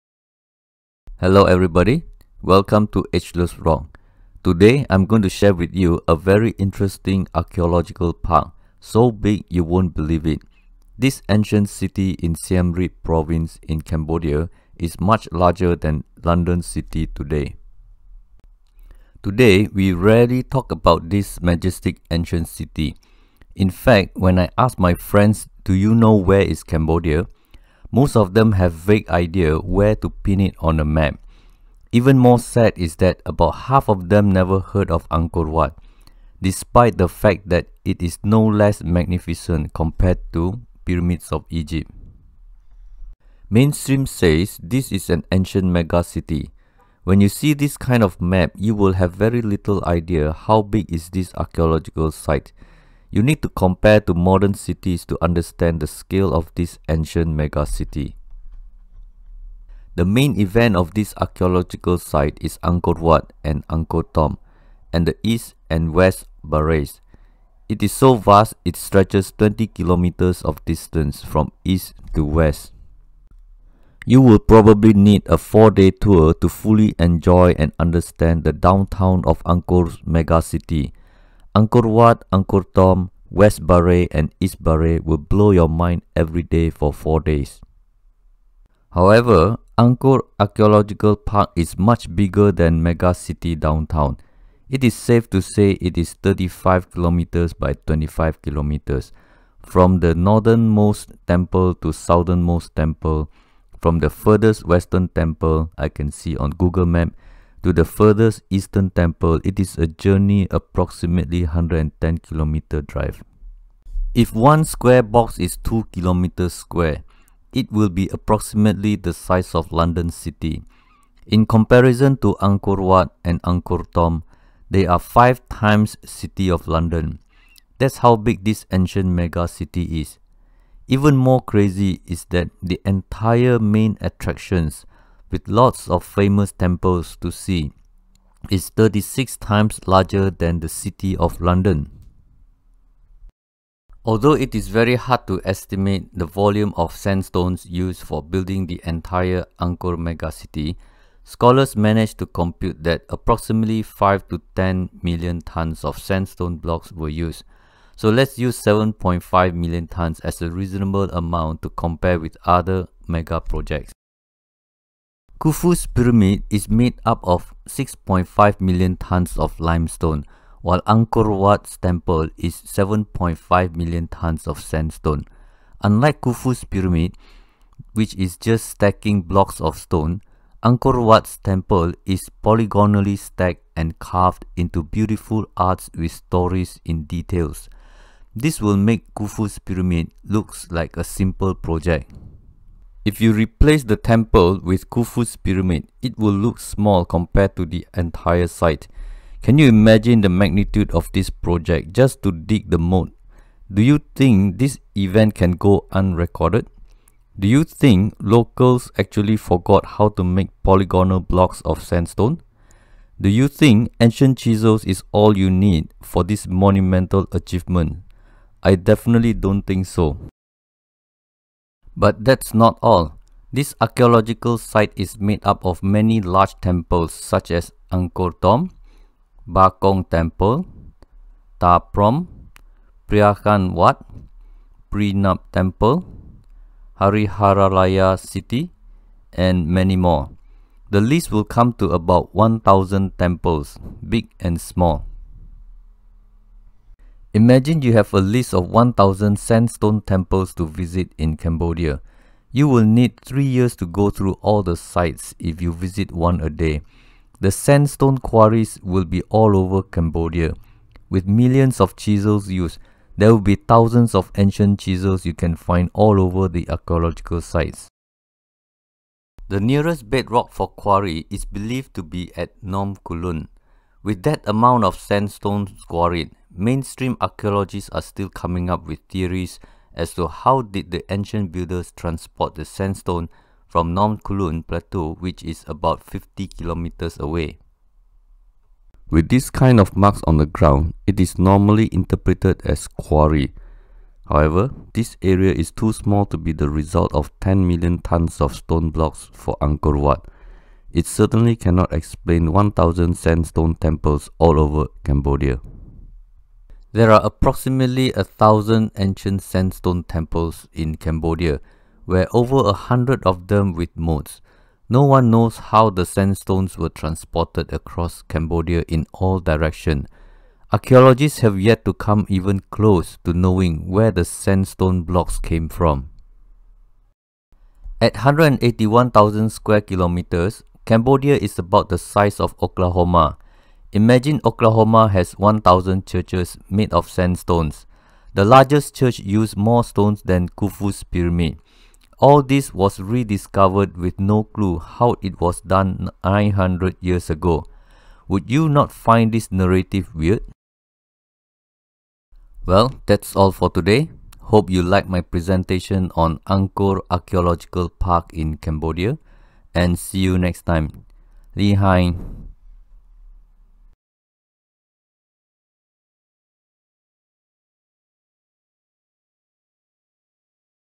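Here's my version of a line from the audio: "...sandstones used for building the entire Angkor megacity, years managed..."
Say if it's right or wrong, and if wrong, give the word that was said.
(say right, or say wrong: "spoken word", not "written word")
wrong: "scholars", not "years".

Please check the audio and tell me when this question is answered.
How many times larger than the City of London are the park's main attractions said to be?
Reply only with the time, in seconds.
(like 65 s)
138 s.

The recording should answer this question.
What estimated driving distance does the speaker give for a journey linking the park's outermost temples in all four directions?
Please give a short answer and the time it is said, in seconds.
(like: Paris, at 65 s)
110 km, at 110 s.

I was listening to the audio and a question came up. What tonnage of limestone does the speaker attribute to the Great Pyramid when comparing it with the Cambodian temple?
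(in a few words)
6.5 million tons.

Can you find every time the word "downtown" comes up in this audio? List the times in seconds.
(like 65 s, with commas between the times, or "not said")
78 s, 93 s.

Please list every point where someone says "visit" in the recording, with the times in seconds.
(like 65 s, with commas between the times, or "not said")
250 s, 255 s.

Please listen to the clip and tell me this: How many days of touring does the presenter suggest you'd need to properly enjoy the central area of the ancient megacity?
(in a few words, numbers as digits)
4.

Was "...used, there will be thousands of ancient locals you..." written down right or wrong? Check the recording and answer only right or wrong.
wrong.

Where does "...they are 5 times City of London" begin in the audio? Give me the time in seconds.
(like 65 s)
124 s.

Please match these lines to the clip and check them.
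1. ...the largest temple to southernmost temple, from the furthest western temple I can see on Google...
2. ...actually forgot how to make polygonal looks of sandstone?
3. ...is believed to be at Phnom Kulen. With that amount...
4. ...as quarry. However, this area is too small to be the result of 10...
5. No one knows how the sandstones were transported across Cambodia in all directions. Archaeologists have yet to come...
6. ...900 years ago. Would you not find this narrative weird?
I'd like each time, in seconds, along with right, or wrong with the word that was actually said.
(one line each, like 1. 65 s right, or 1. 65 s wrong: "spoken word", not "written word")
1. 99 s wrong: "northernmost", not "largest"
2. 208 s wrong: "blocks", not "looks"
3. 271 s right
4. 292 s right
5. 314 s right
6. 346 s right.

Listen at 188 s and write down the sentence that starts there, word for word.
This will make Khufu's pyramid looks like a simple project.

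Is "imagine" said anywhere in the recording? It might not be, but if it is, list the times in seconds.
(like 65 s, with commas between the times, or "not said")
199 s, 247 s, 333 s.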